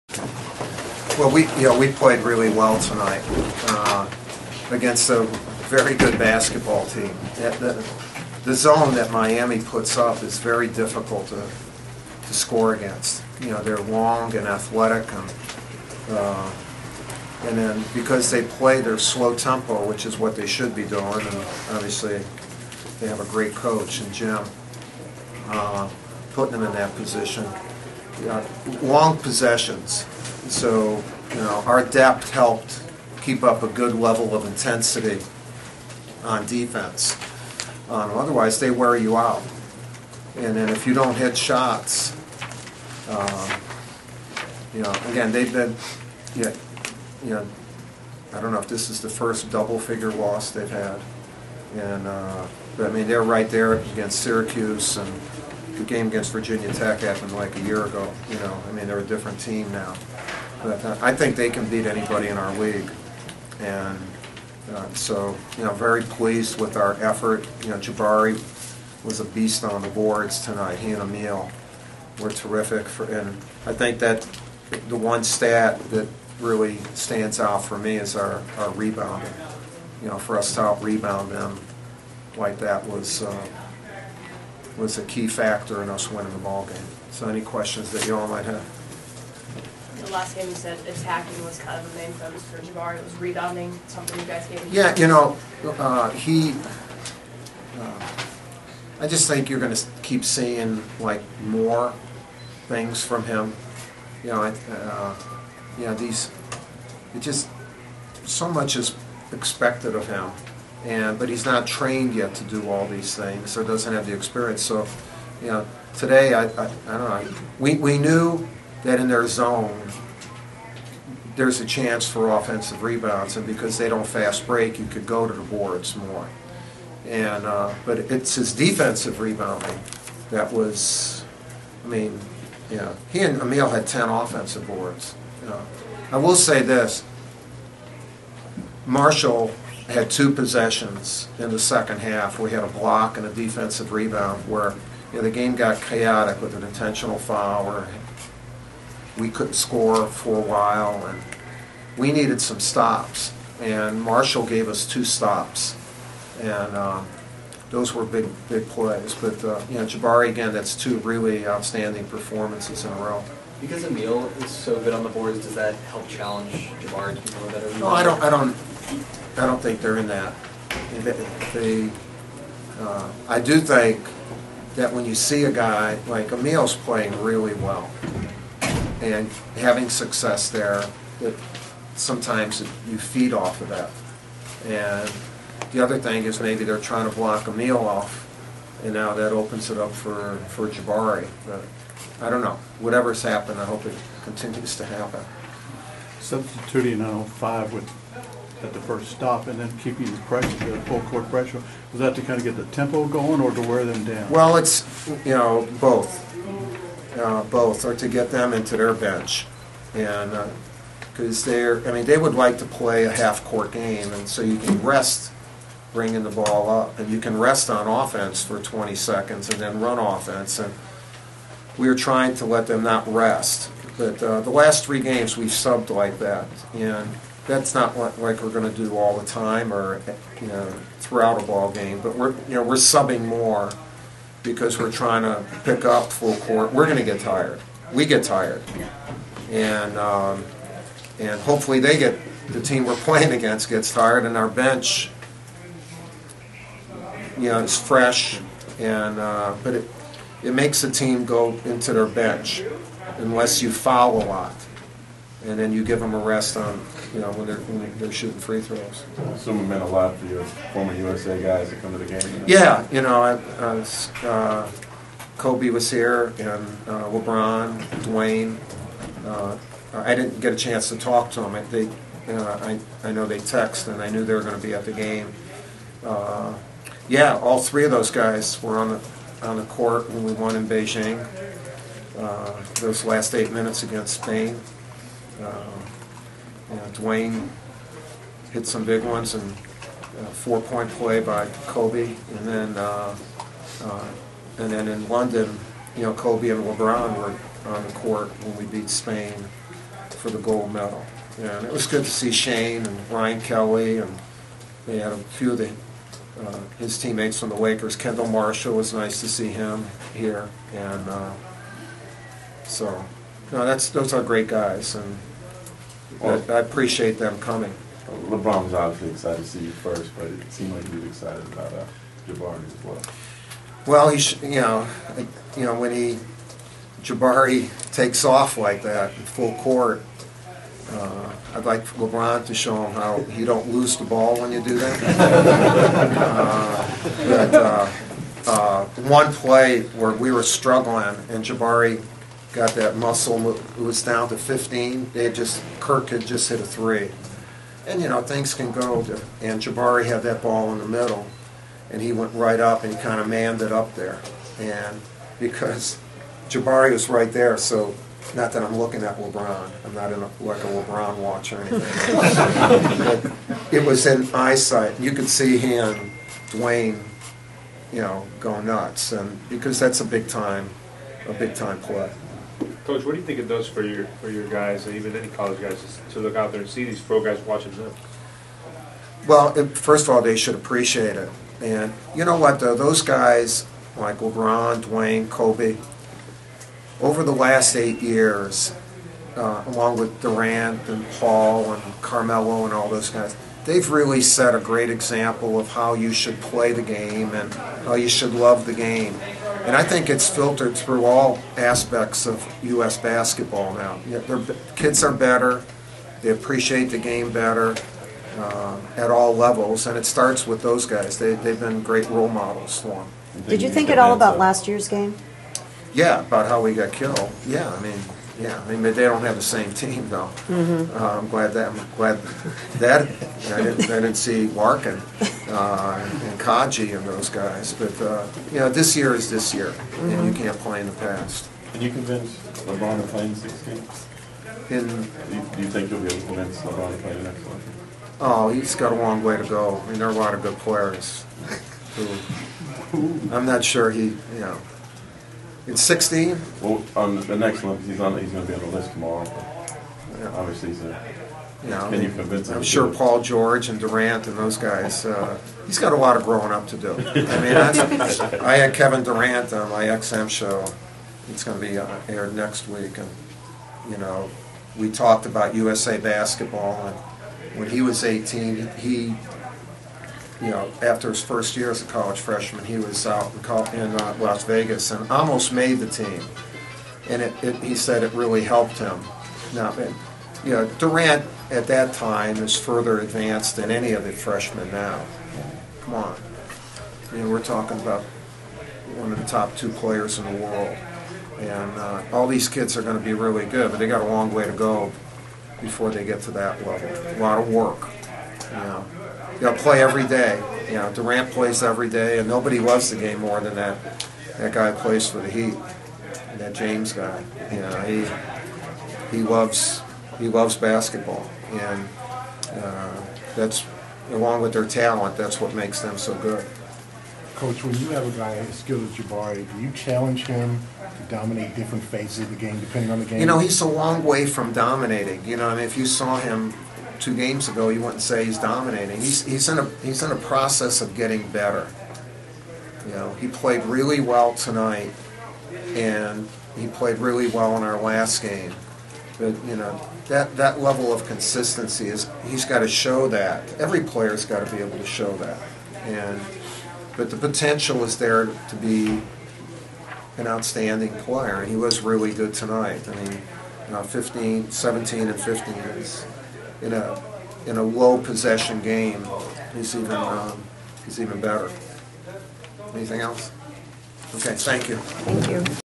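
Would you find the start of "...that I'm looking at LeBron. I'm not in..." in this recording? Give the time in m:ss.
5:58.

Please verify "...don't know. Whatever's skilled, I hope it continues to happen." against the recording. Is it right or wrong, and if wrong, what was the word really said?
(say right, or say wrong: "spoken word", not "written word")
wrong: "happened", not "skilled".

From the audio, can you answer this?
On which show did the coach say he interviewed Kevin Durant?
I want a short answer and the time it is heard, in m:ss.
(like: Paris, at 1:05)
XM show, at 7:39.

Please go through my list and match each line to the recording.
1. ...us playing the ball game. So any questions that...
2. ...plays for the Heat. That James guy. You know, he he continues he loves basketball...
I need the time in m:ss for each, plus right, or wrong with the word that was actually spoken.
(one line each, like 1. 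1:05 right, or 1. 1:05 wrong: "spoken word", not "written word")
1. 1:25 wrong: "winning", not "playing"
2. 8:24 wrong: "loves", not "continues".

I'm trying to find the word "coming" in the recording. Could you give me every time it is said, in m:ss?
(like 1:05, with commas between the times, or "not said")
5:17.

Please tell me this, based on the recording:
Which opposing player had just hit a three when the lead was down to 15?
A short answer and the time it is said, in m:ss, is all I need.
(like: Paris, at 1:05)
Kirk, at 5:45.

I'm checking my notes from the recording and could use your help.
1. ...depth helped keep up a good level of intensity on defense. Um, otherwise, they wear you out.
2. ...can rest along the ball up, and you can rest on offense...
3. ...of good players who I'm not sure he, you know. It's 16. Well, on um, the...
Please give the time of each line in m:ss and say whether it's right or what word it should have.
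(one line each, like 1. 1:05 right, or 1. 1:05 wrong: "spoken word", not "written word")
1. 0:31 right
2. 3:34 wrong: "bringing", not "along"
3. 7:20 right.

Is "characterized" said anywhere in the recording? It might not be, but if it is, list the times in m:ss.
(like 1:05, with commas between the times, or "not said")
not said.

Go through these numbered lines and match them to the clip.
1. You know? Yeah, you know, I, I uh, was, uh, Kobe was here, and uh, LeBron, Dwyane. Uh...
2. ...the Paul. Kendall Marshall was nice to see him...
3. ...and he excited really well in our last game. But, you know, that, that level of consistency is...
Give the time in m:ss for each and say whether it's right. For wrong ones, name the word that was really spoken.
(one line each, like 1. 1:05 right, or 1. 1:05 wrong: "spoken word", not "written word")
1. 4:22 right
2. 5:07 wrong: "Lakers", not "Paul"
3. 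8:55 wrong: "played", not "excited".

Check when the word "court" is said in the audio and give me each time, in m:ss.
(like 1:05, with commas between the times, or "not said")
3:21, 3:33, 3:56, 4:39, 4:57, 5:29.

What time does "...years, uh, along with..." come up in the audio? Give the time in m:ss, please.
6:28.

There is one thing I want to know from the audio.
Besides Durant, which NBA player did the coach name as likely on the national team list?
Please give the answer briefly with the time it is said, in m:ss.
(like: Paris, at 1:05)
Paul George, at 7:32.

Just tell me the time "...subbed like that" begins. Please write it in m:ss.
3:45.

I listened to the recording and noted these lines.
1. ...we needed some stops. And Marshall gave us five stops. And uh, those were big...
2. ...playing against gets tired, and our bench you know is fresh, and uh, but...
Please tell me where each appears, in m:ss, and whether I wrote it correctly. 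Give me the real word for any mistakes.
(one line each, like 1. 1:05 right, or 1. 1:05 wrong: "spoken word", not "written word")
1. 2:31 wrong: "two", not "five"
2. 4:02 right.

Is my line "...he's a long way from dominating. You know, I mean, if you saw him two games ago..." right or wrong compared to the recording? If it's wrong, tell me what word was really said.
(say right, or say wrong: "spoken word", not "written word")
right.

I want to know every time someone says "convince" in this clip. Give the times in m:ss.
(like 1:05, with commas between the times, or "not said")
7:11, 7:16.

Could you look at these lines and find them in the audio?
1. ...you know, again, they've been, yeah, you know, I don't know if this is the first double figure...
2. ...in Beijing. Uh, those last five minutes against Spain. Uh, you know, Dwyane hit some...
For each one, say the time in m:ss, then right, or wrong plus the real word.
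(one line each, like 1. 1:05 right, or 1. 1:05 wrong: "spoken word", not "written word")
1. 0:44 right
2. 4:40 wrong: "eight", not "five".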